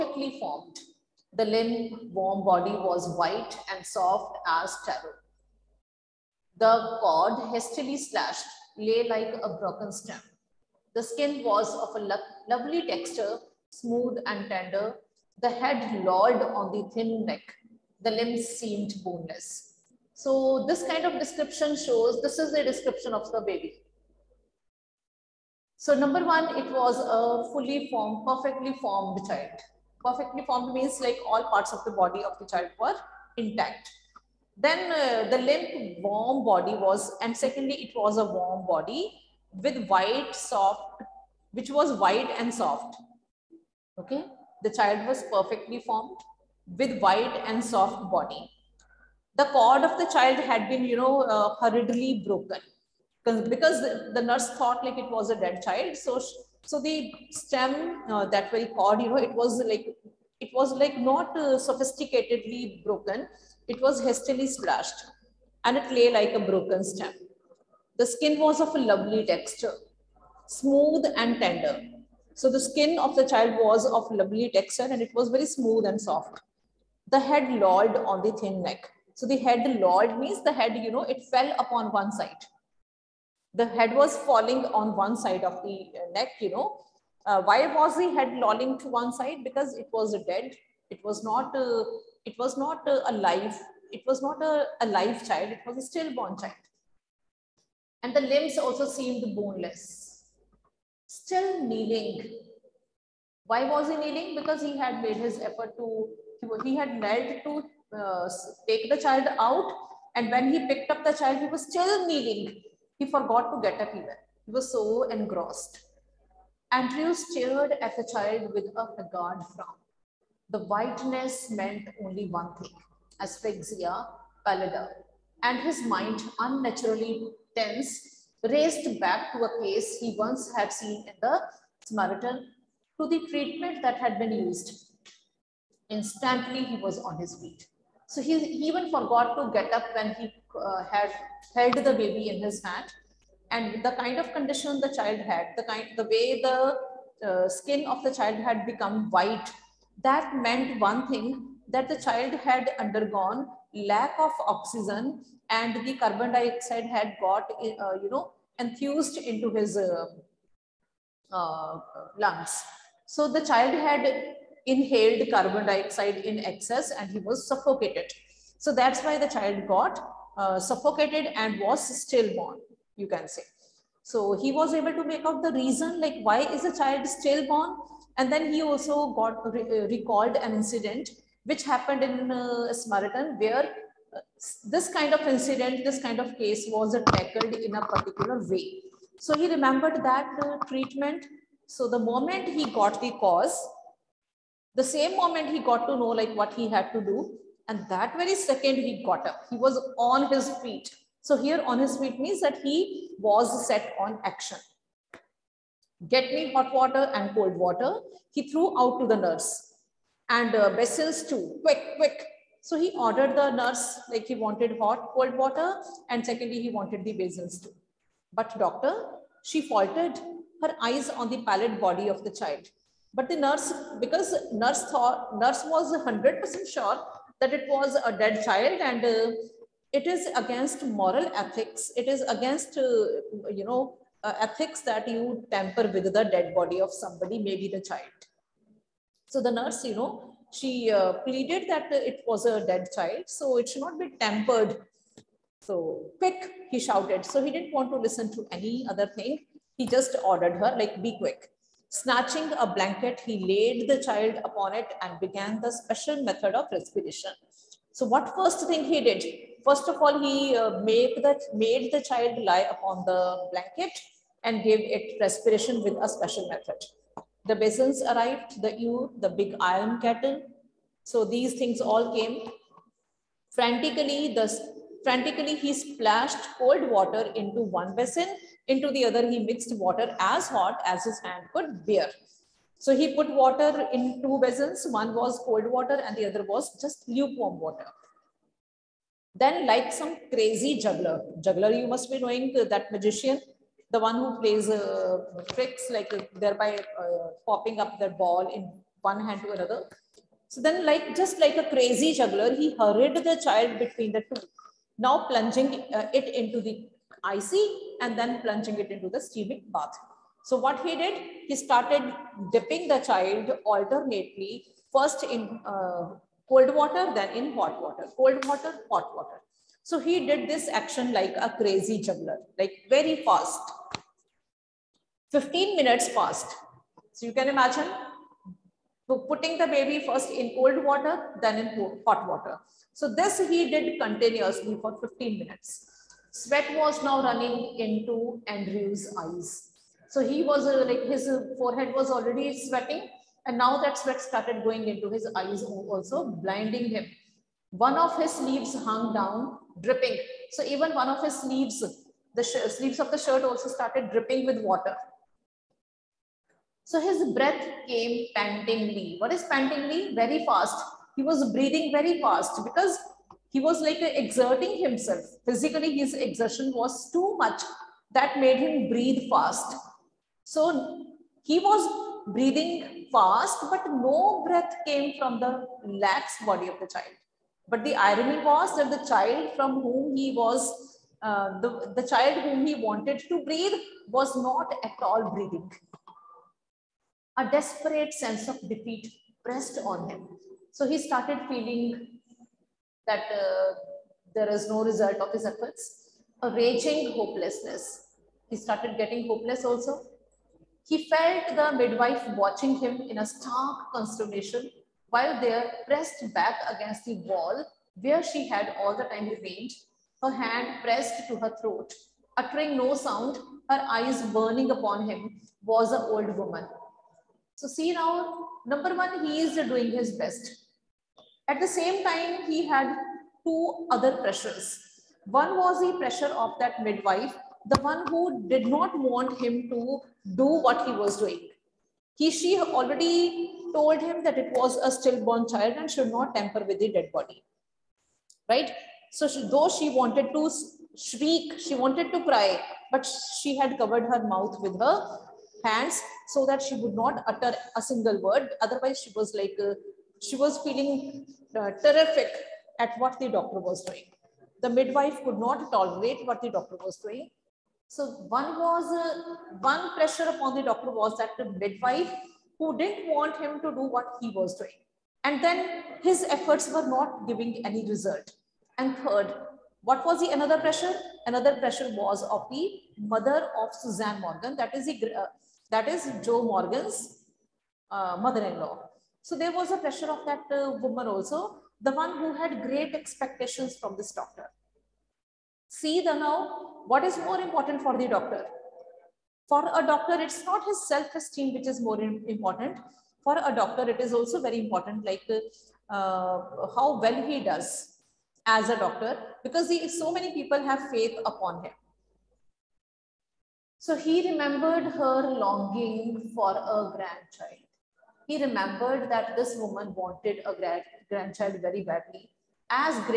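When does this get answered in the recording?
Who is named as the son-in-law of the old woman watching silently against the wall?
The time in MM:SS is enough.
07:56.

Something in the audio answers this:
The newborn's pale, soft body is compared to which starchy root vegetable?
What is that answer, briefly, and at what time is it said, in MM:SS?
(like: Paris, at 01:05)
Taro, at 00:04.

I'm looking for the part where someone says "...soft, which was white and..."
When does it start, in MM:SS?
00:40.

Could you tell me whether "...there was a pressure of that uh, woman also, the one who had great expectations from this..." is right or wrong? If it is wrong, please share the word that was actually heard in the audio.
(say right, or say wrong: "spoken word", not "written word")
right.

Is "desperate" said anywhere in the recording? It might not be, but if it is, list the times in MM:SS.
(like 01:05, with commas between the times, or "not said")
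06:27.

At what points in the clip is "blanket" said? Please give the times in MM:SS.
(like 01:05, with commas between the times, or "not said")
04:12, 04:23.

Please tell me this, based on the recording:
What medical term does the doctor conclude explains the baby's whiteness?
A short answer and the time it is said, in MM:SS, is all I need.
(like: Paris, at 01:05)
Asphyxia pallida, at 02:03.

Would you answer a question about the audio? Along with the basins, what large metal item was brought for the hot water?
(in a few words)
Big iron kettle.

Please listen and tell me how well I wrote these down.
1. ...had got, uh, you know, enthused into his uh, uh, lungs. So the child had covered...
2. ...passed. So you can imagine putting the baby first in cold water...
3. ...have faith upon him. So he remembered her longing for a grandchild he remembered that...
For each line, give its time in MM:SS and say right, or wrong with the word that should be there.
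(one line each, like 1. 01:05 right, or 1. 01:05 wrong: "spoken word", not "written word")
1. 02:36 wrong: "inhaled", not "covered"
2. 05:26 right
3. 08:20 right.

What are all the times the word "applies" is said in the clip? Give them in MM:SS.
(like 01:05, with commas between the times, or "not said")
not said.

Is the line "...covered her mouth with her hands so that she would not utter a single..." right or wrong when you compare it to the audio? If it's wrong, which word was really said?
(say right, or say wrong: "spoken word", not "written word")
right.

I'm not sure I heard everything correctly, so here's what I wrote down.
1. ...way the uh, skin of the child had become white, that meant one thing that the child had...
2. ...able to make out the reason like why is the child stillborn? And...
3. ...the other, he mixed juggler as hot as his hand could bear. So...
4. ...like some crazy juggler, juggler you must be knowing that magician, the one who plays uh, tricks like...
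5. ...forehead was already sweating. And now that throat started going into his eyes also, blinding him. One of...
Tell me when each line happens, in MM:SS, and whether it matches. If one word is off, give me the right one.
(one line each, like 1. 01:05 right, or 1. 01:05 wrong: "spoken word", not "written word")
1. 02:26 right
2. 02:54 right
3. 04:38 wrong: "water", not "juggler"
4. 04:49 right
5. 05:41 wrong: "sweat", not "throat".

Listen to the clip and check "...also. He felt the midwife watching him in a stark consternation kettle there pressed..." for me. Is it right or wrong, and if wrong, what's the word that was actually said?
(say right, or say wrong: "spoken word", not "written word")
wrong: "while", not "kettle".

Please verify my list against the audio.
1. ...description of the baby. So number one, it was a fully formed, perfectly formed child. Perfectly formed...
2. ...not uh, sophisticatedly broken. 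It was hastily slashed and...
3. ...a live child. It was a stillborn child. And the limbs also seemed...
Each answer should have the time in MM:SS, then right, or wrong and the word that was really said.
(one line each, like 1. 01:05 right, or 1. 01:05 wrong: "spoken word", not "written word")
1. 00:22 right
2. 01:00 right
3. 01:34 right.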